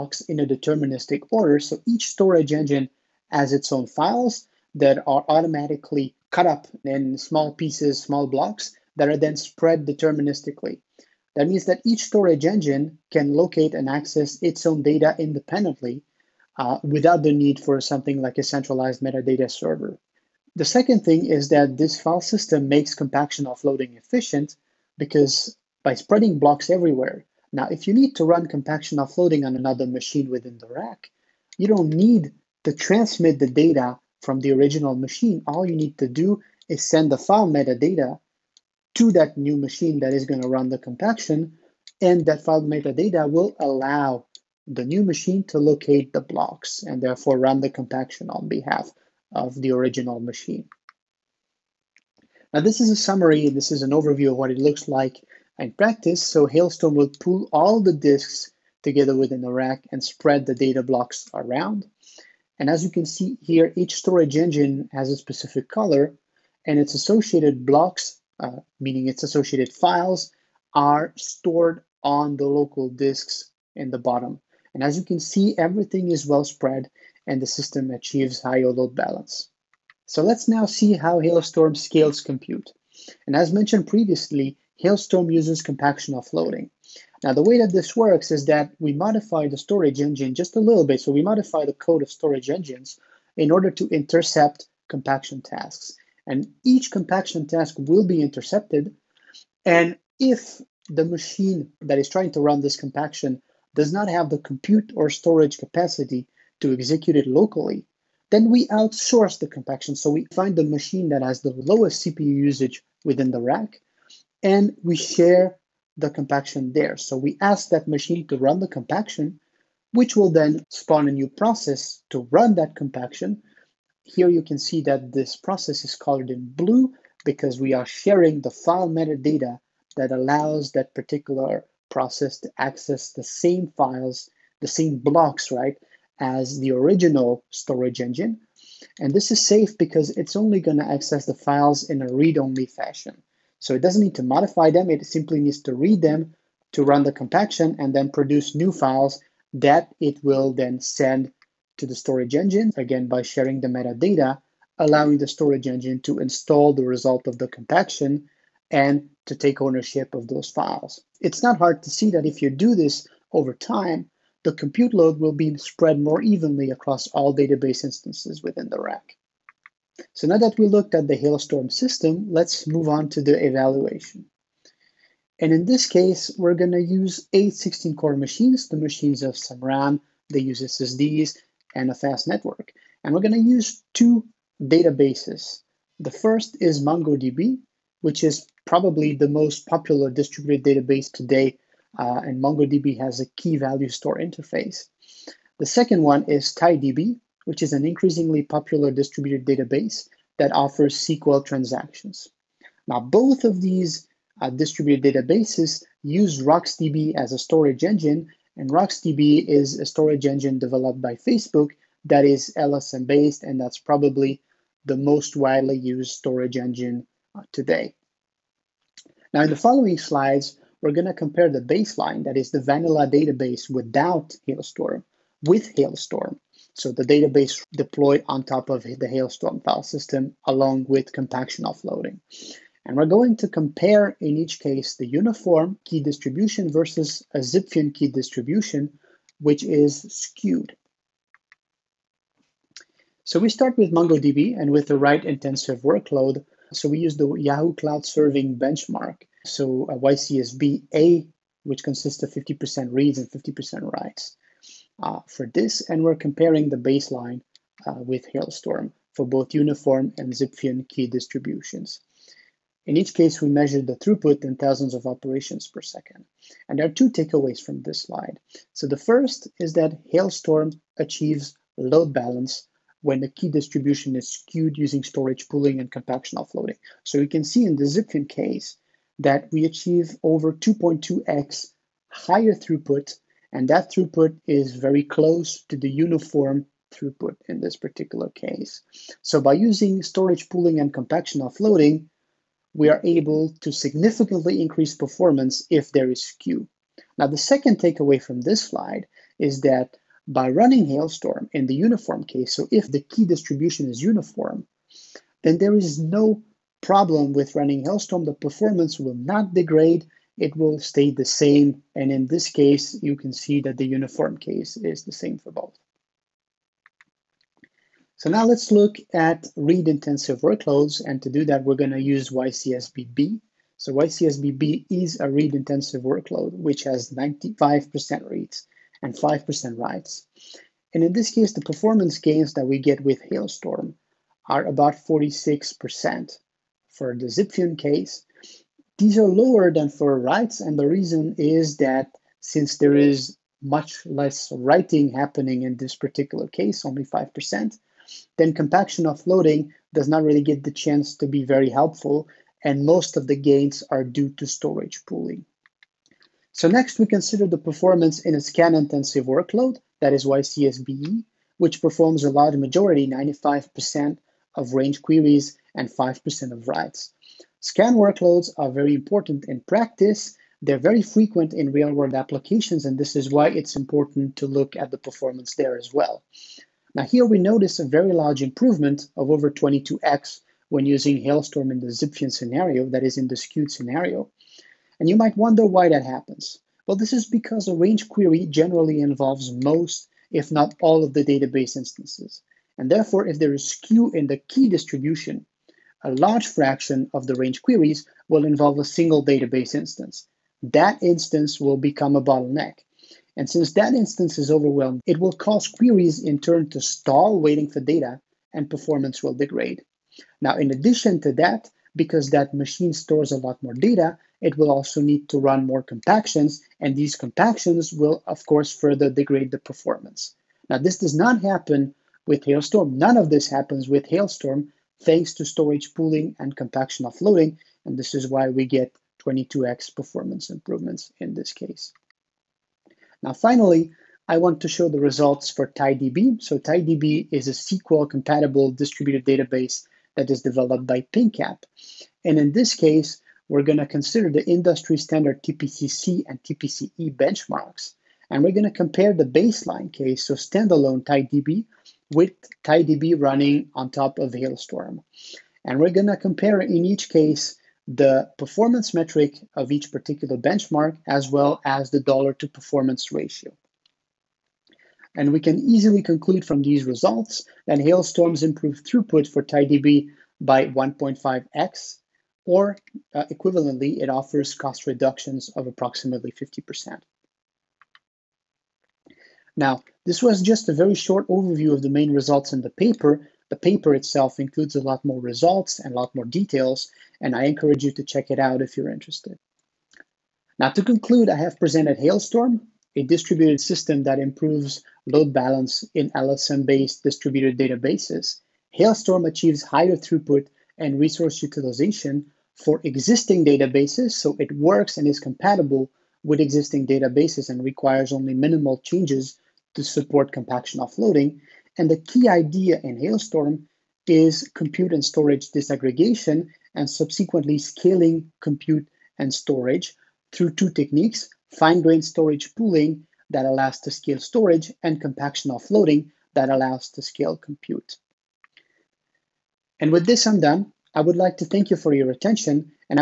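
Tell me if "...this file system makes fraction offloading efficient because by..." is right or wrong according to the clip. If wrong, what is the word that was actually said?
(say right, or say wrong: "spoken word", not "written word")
wrong: "compaction", not "fraction".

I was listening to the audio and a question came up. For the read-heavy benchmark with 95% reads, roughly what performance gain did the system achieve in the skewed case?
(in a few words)
46%.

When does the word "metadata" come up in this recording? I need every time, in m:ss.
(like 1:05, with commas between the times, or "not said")
0:19, 0:37, 0:42, 2:08, 2:33.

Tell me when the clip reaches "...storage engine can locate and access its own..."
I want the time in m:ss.
0:12.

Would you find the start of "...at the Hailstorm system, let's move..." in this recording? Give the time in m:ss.
2:50.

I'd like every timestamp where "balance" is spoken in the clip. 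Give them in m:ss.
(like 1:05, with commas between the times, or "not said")
1:18, 4:32, 8:15.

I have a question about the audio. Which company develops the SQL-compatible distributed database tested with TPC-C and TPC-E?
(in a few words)
PingCap.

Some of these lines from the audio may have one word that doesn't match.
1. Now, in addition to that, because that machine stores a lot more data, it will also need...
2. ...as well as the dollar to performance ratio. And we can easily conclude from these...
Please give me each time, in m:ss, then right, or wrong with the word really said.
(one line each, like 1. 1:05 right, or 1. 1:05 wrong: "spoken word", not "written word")
1. 6:50 right
2. 7:41 right.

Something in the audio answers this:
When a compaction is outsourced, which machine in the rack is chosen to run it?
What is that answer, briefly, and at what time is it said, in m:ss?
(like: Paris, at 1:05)
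Lowest CPU usage, at 1:51.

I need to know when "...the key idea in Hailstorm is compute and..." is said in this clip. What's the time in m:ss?
8:31.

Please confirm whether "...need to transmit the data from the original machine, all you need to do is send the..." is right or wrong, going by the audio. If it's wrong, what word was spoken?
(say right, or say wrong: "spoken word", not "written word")
right.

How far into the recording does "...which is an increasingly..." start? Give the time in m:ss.
3:17.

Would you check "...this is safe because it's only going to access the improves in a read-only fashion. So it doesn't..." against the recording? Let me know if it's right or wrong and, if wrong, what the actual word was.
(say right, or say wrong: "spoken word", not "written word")
wrong: "files", not "improves".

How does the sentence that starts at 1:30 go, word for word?
So we modify the code of storage engines in order to intercept compaction tasks.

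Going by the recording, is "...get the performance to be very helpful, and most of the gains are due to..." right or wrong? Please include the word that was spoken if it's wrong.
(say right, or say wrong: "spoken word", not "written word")
wrong: "chance", not "performance".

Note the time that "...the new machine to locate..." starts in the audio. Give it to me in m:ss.
0:44.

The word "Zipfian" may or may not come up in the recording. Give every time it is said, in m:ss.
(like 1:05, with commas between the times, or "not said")
3:57, 4:20, 4:37, 5:37, 6:21.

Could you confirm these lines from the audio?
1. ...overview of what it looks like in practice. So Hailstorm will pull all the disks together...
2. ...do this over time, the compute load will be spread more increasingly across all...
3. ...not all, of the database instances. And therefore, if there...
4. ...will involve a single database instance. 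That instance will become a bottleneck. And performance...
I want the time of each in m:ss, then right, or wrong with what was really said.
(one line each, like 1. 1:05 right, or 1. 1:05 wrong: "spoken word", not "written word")
1. 0:53 right
2. 2:42 wrong: "evenly", not "increasingly"
3. 6:30 right
4. 6:38 wrong: "since", not "performance".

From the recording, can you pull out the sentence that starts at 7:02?
None of this happens with Hailstorm thanks to storage pooling and compaction offloading.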